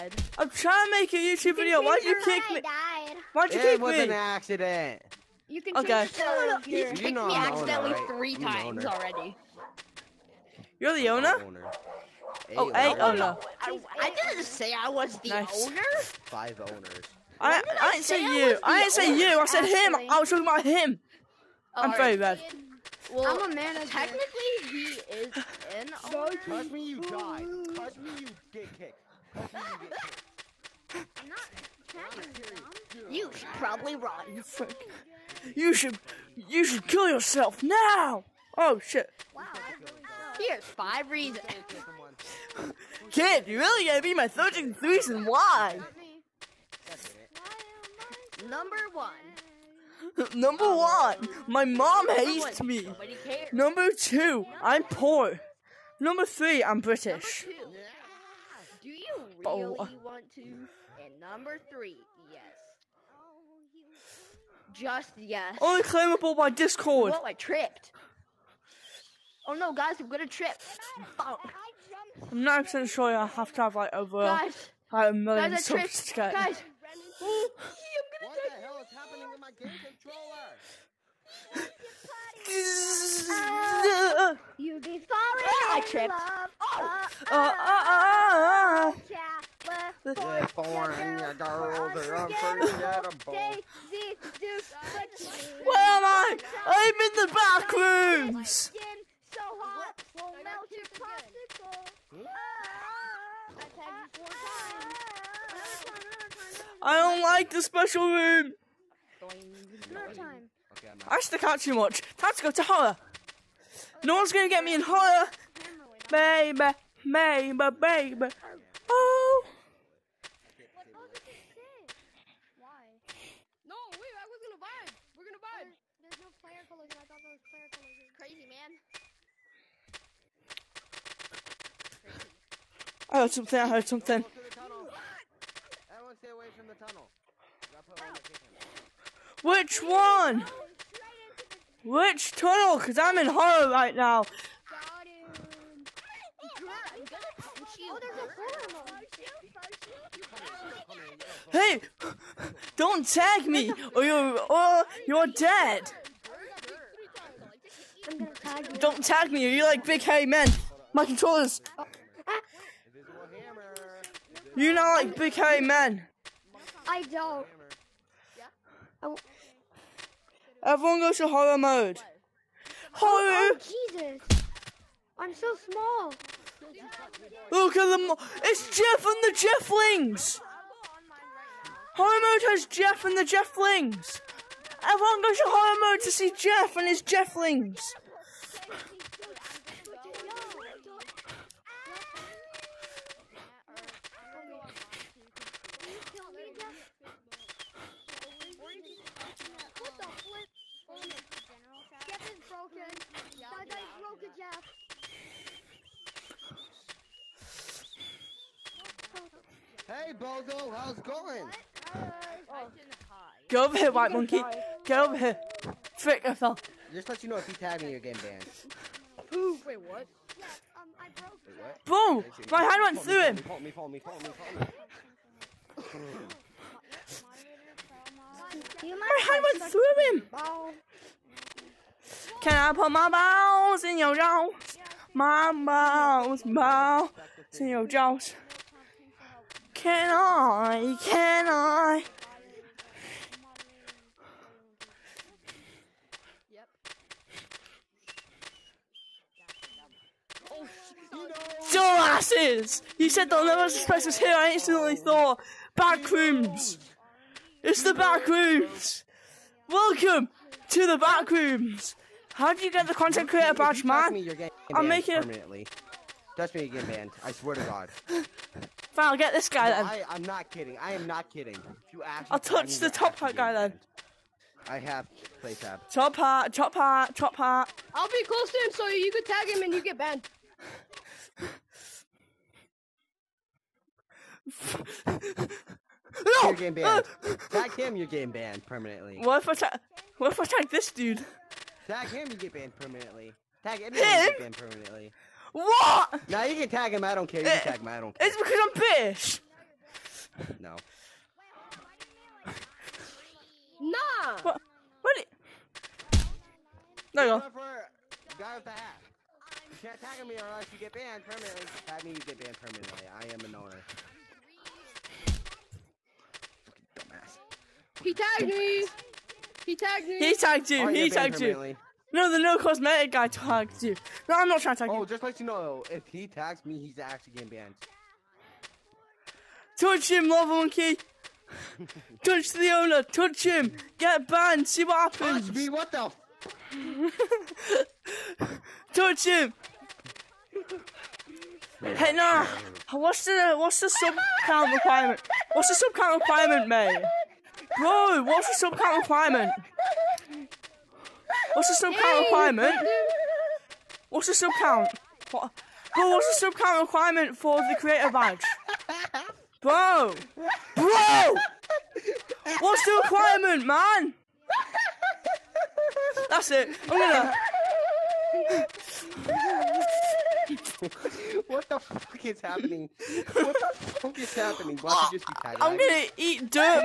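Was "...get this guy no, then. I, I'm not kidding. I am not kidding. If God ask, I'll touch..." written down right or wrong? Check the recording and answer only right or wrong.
wrong.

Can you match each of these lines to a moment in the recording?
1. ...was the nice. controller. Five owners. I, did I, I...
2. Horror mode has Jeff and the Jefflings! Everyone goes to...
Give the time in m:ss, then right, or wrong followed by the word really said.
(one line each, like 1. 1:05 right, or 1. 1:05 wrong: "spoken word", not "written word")
1. 0:14 wrong: "owner", not "controller"
2. 3:01 right.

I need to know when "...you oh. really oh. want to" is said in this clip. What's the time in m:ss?
0:58.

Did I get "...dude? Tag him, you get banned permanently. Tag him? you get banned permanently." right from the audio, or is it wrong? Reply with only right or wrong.
right.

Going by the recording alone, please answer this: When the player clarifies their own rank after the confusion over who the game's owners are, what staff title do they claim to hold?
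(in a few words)
Manager.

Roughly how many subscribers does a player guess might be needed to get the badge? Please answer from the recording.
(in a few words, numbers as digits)
1,000,000.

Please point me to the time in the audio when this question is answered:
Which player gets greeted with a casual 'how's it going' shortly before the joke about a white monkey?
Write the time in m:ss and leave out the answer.
3:30.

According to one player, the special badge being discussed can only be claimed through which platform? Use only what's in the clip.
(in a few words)
Discord.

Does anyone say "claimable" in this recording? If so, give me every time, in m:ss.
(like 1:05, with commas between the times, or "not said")
1:05.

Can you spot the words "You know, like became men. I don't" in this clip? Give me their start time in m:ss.
2:44.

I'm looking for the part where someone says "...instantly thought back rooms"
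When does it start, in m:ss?
4:14.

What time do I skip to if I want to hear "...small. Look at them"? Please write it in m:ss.
2:55.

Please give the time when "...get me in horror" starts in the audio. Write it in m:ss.
1:54.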